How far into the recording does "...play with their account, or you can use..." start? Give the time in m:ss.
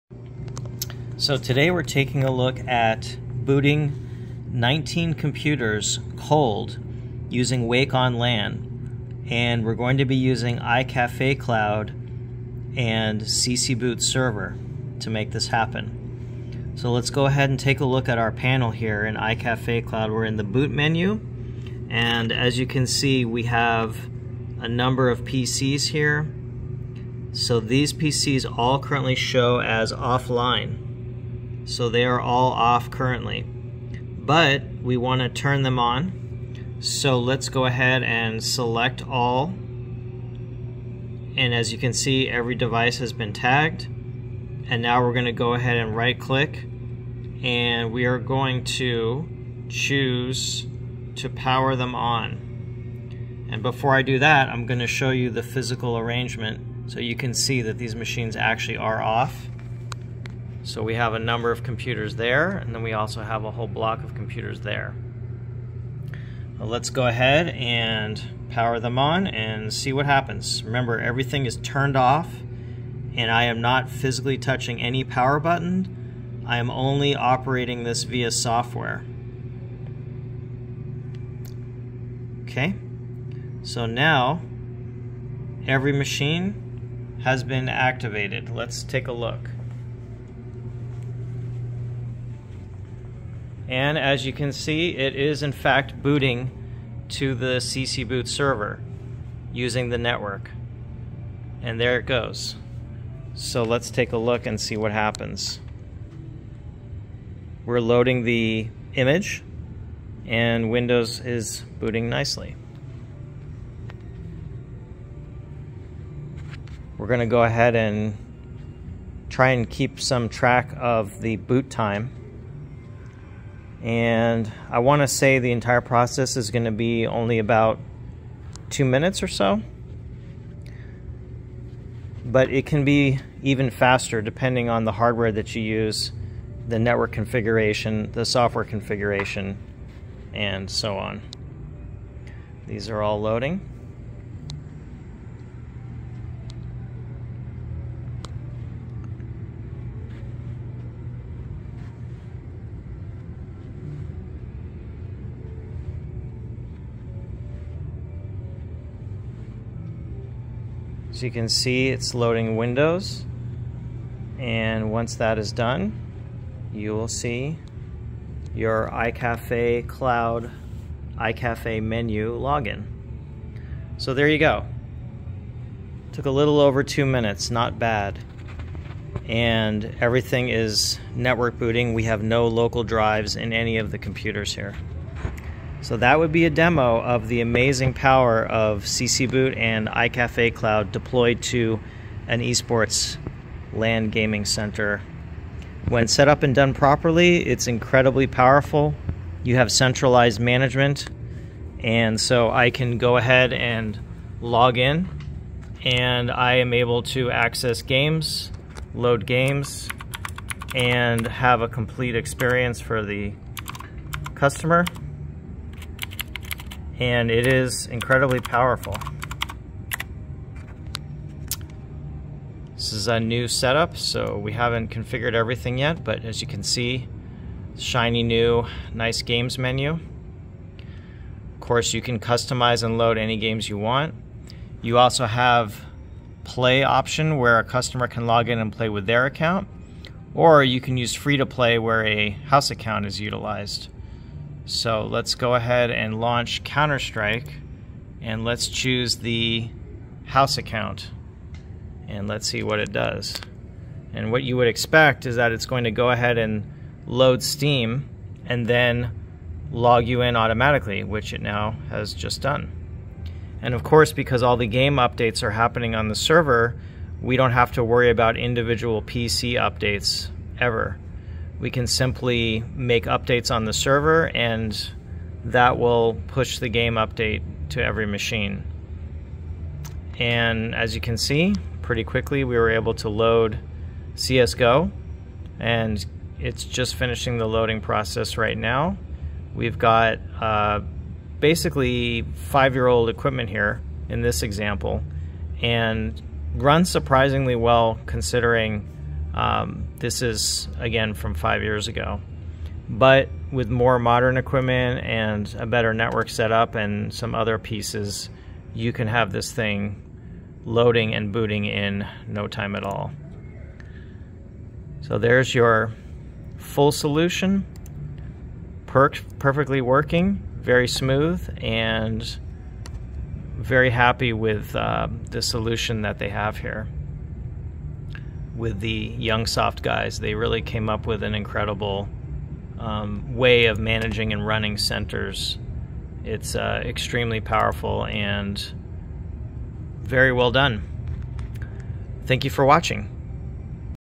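3:58.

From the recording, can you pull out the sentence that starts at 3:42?
This is a new setup, so we haven't configured everything yet, but as you can see, shiny new, nice games menu.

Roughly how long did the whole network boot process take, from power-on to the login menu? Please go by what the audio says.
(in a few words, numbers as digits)
A little over 2 minutes.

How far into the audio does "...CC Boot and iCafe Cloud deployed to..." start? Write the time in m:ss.
3:08.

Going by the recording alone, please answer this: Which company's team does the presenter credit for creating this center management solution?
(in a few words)
Youngzsoft.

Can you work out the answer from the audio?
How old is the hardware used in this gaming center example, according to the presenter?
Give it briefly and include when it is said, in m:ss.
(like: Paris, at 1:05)
5 years old, at 4:52.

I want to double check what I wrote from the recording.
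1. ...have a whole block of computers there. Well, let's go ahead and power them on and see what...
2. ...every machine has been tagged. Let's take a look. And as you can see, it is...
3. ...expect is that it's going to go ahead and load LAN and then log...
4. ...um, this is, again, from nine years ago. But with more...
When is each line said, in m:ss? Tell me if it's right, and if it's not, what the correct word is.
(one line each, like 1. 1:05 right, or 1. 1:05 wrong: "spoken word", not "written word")
1. 1:03 right
2. 1:25 wrong: "activated", not "tagged"
3. 4:14 wrong: "Steam", not "LAN"
4. 4:59 wrong: "five", not "nine".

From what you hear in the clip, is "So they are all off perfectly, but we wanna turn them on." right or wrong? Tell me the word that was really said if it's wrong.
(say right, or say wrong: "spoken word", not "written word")
wrong: "currently", not "perfectly".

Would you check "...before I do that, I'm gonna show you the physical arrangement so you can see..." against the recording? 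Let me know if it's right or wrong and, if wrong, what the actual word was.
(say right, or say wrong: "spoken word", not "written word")
right.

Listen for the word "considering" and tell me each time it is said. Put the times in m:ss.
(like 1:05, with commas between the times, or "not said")
4:58.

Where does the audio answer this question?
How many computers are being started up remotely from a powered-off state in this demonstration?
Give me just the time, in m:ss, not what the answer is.
0:04.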